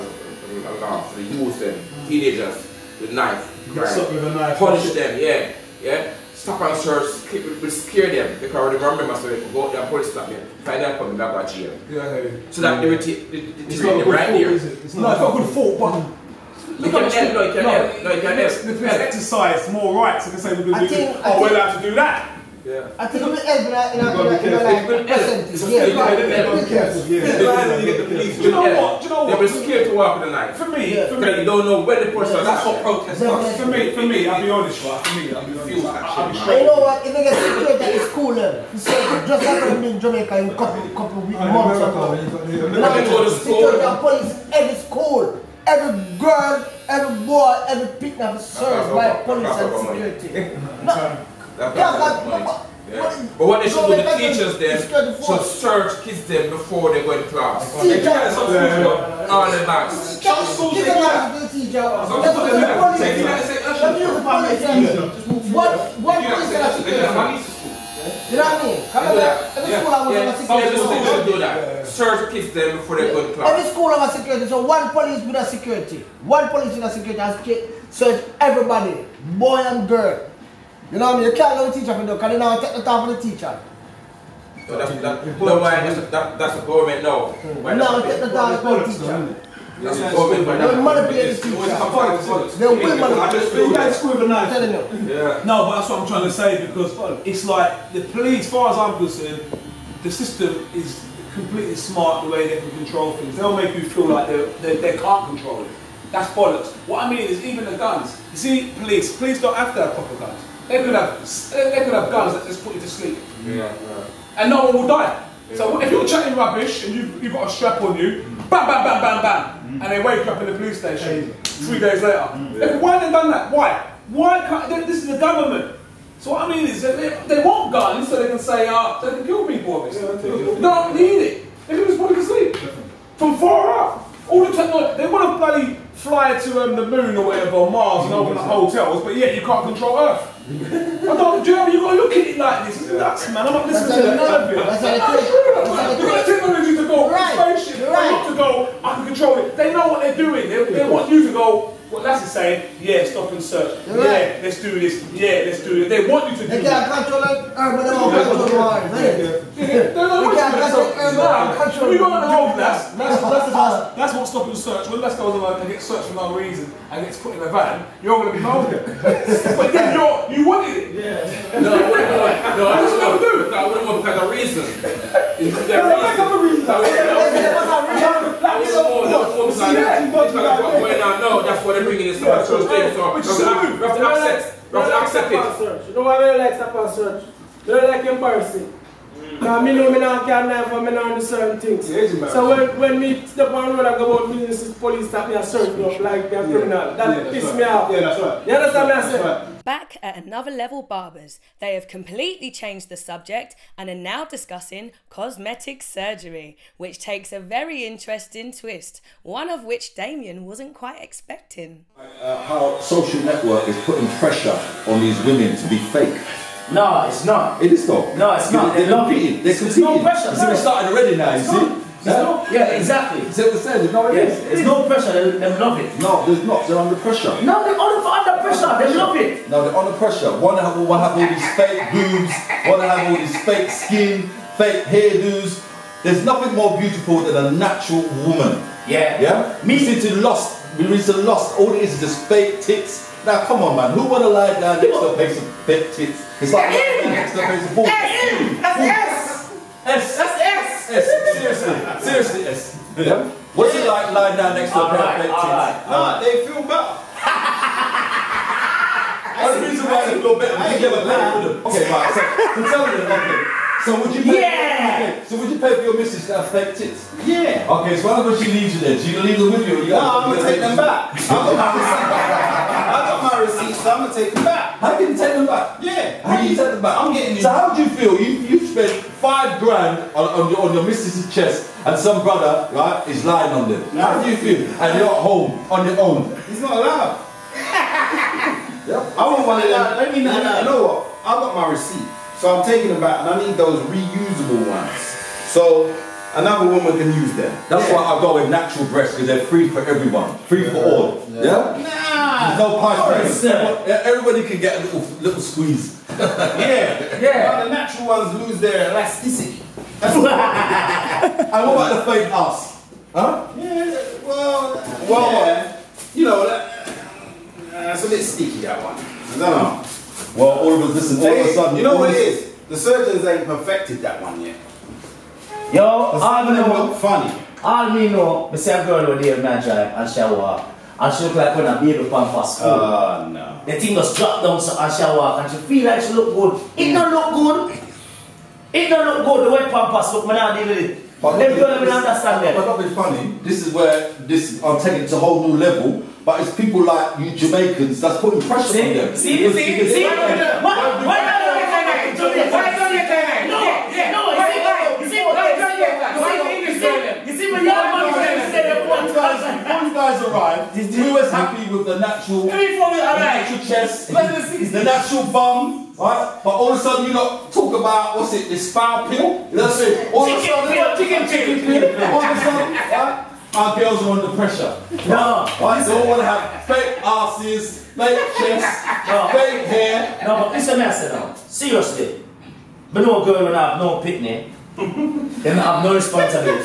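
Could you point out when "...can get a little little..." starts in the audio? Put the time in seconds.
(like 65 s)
304 s.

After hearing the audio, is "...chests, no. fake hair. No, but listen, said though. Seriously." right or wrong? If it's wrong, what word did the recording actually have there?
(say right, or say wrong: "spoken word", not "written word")
right.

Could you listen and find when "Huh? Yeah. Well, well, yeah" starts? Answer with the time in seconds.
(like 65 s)
313 s.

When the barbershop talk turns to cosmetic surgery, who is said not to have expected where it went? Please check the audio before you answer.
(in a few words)
Damien.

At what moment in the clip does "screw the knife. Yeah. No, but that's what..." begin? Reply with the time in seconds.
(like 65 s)
93 s.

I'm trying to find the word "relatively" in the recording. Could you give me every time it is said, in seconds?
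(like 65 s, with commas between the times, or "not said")
not said.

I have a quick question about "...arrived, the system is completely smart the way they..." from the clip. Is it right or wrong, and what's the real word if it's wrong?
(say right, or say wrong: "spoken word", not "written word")
wrong: "concerned", not "arrived".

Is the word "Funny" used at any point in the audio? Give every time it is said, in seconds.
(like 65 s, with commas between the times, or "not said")
326 s.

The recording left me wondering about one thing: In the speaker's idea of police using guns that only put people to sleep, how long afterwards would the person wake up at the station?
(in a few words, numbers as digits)
3 days.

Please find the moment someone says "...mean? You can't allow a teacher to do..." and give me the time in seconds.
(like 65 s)
81 s.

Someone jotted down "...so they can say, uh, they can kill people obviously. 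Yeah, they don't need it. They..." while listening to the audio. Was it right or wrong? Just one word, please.
right.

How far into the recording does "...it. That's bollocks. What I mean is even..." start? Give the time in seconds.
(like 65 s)
105 s.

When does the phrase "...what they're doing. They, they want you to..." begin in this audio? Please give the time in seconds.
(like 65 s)
149 s.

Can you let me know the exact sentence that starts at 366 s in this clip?
But all of a sudden you not talk about what's it, this foul pill?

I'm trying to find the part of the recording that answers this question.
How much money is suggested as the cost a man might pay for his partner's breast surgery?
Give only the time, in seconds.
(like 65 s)
279 s.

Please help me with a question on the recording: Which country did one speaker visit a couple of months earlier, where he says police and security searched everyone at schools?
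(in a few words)
Jamaica.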